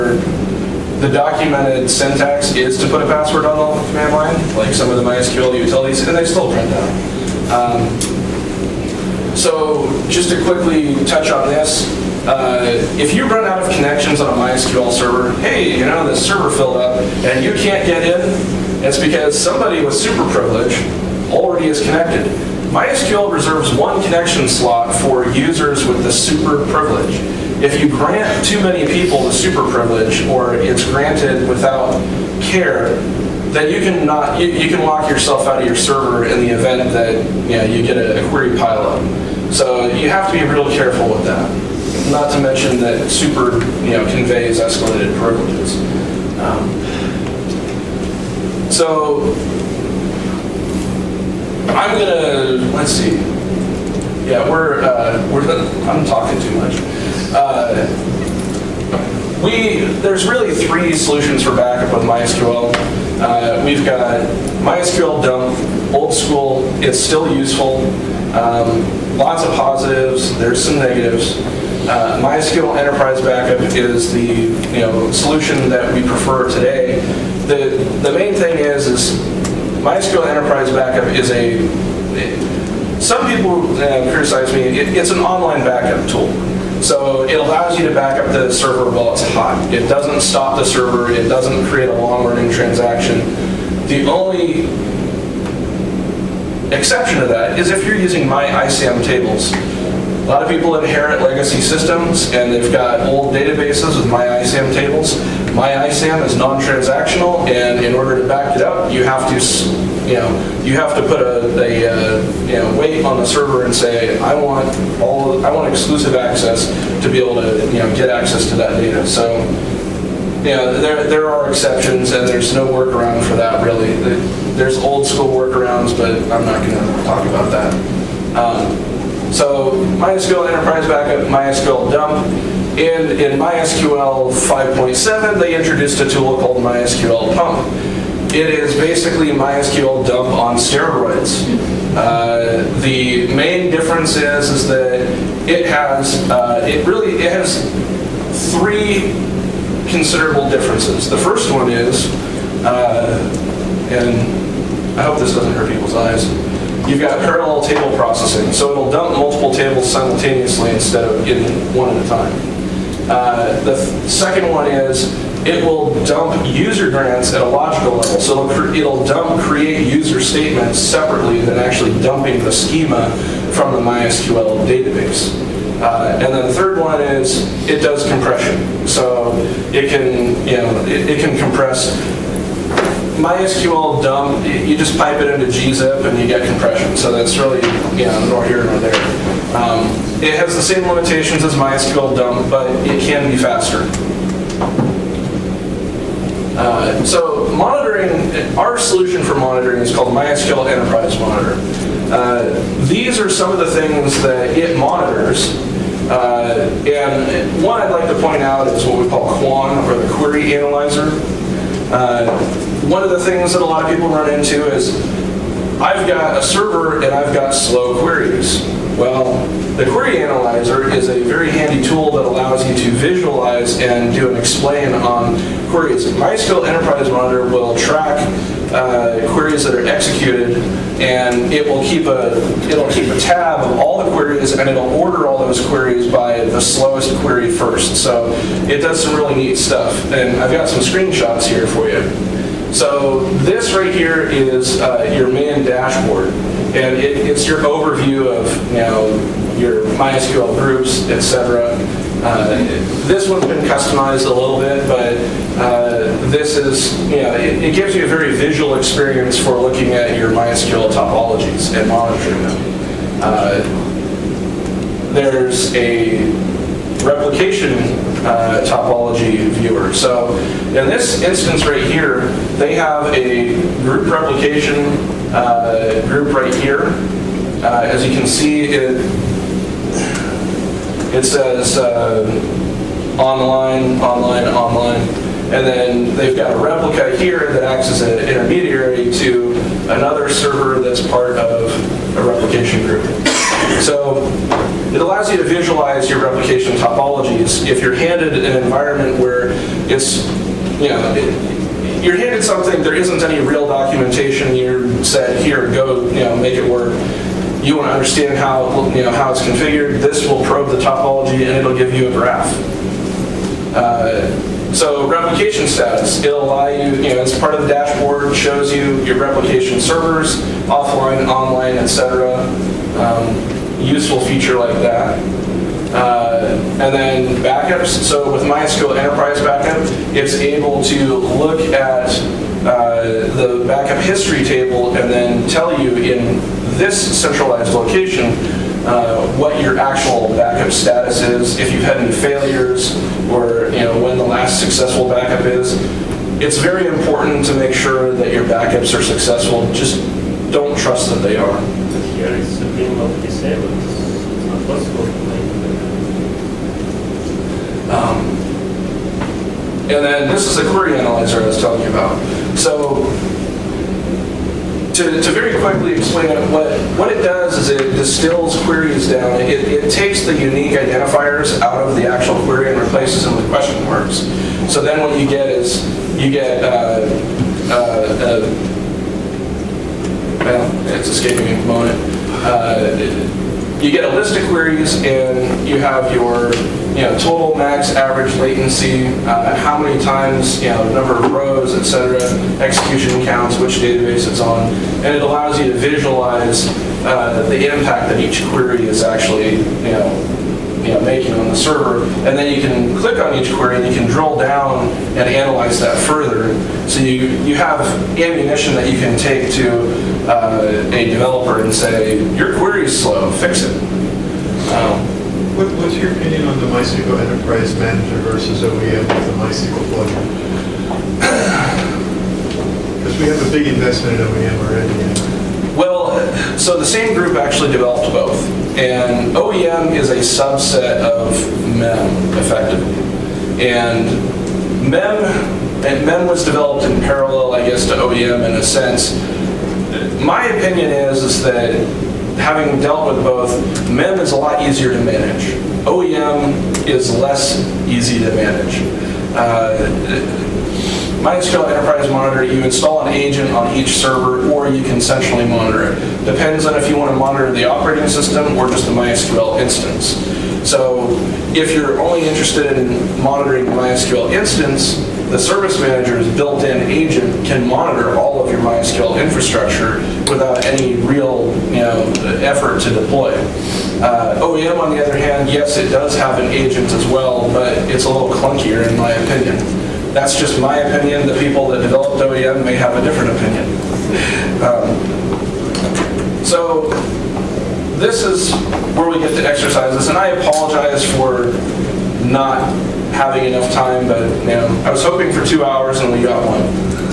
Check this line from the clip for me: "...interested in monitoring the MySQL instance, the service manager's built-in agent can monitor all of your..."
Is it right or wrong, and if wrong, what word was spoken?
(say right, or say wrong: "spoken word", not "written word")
right.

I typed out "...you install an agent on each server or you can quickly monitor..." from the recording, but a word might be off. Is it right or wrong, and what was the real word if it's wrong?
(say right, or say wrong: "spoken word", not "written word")
wrong: "centrally", not "quickly".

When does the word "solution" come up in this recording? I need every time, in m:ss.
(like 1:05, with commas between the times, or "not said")
1:00, 1:15, 3:18.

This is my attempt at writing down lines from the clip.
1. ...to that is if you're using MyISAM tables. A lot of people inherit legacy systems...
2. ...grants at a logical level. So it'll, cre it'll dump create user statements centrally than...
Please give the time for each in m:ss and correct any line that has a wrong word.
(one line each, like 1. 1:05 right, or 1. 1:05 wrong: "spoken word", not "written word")
1. 1:37 right
2. 2:46 wrong: "separately", not "centrally".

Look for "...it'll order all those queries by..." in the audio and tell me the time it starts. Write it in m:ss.
3:54.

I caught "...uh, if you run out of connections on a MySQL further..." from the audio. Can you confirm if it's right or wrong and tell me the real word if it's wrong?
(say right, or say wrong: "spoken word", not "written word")
wrong: "server", not "further".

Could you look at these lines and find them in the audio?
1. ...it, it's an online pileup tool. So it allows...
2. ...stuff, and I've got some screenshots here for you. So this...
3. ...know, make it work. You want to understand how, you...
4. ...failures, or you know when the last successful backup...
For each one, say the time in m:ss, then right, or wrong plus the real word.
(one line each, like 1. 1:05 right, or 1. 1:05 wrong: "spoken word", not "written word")
1. 1:24 wrong: "backup", not "pileup"
2. 3:59 right
3. 5:06 right
4. 5:42 right.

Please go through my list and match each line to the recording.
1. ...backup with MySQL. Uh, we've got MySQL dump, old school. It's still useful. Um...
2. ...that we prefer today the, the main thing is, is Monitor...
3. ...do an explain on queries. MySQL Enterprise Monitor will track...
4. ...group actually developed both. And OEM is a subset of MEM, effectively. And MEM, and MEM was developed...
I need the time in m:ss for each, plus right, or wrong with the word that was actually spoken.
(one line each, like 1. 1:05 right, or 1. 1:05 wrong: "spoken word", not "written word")
1. 1:01 right
2. 1:15 wrong: "MySQL", not "Monitor"
3. 3:44 right
4. 7:07 right.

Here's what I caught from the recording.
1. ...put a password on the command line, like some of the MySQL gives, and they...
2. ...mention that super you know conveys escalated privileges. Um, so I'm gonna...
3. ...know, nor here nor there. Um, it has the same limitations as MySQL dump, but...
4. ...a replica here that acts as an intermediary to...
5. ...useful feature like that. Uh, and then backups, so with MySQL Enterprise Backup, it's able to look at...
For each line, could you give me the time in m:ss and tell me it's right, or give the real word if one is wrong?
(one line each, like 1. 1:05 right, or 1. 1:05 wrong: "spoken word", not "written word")
1. 0:02 wrong: "utilities", not "gives"
2. 0:42 right
3. 3:08 right
4. 4:46 right
5. 5:23 right.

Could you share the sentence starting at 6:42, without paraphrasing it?
And then you can click on each query and you can drill down and analyze that further.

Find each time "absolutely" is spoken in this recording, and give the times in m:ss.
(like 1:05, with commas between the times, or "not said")
not said.